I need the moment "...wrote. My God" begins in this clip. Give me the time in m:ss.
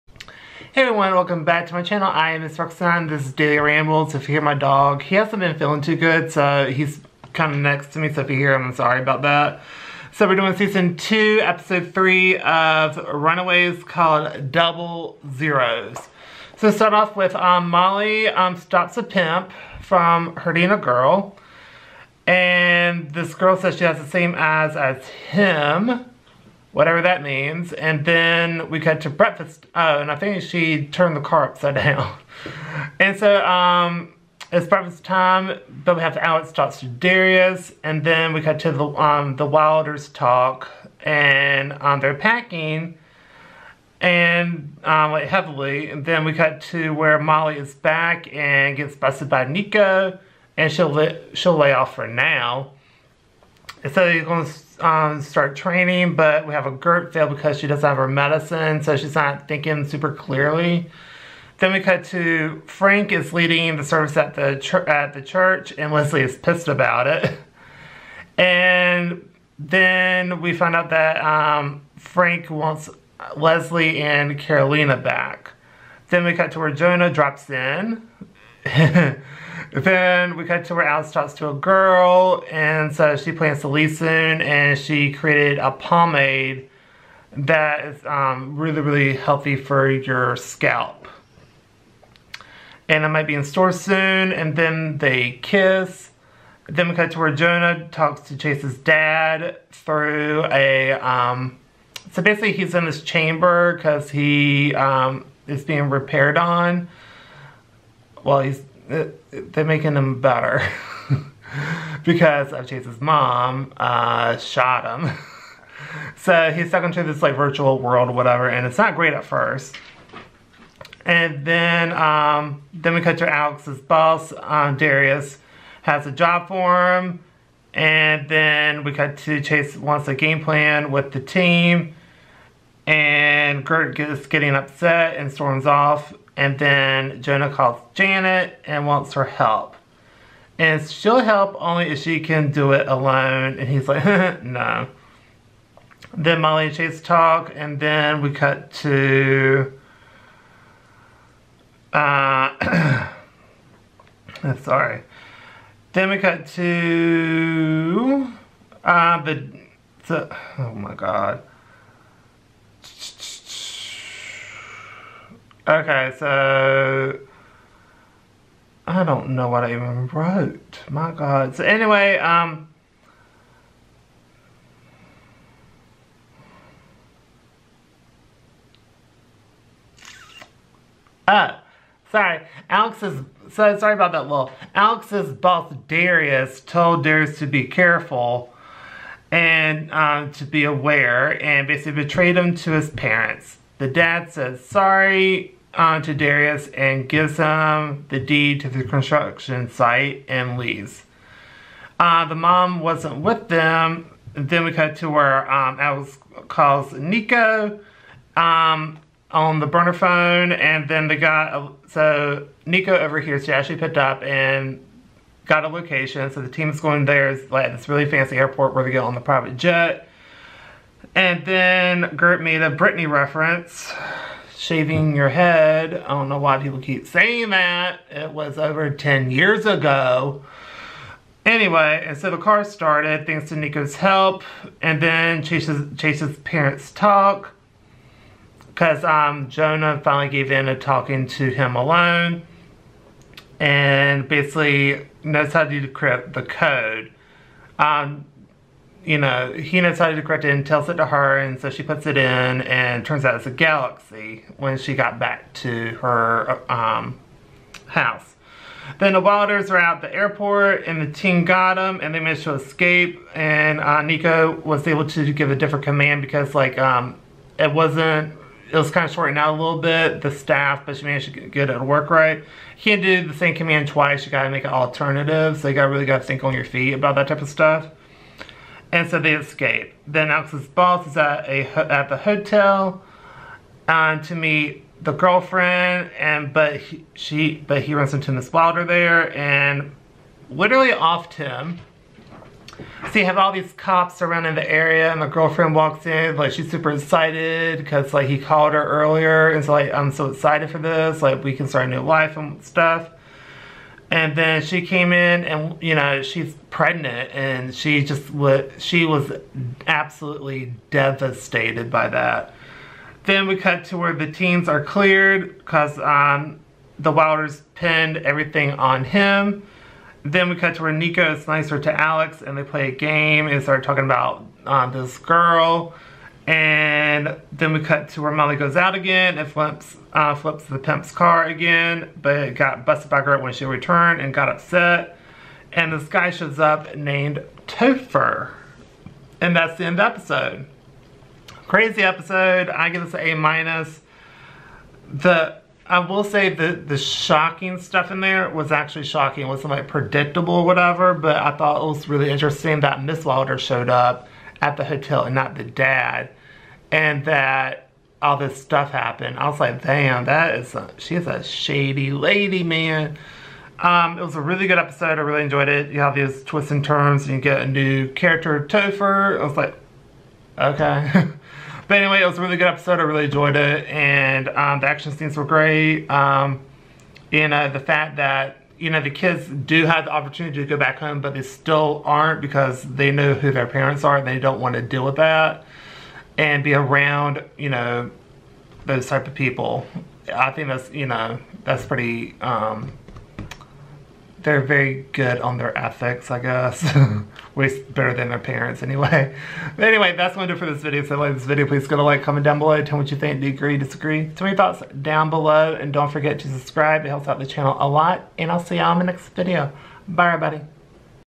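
2:50.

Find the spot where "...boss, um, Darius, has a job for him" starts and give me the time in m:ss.
2:03.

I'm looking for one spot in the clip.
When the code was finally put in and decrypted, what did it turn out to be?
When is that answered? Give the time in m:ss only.
4:13.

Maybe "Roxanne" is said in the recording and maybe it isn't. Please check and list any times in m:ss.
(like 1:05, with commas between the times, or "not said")
0:02.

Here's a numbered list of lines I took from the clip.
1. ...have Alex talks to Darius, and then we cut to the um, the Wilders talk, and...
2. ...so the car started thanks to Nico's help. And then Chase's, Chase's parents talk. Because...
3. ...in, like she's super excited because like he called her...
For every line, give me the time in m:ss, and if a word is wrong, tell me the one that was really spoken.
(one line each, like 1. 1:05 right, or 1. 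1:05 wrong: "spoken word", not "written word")
1. 0:36 right
2. 3:52 right
3. 4:56 right.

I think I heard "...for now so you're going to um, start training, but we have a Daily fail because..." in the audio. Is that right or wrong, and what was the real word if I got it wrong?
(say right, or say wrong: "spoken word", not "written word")
wrong: "Gert", not "Daily".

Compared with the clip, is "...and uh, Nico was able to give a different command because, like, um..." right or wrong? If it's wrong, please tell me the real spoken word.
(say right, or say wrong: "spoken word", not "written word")
right.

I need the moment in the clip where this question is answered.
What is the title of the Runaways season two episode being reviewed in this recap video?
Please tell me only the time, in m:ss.
0:14.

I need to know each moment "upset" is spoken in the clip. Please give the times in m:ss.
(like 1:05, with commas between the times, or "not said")
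2:14, 5:34.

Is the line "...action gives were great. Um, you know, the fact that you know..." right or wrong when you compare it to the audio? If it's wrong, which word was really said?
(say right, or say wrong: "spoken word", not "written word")
wrong: "scenes", not "gives".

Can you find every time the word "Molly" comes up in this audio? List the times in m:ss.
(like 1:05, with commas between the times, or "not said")
0:17, 0:47, 2:26, 5:28.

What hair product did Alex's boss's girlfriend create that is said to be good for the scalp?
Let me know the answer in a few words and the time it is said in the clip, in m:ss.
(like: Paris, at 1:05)
pomade, at 1:25.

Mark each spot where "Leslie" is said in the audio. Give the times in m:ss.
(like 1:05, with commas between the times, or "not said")
1:05, 1:13.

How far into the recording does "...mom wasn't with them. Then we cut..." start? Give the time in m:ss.
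3:22.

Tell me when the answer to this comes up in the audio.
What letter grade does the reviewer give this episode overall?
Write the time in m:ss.
5:43.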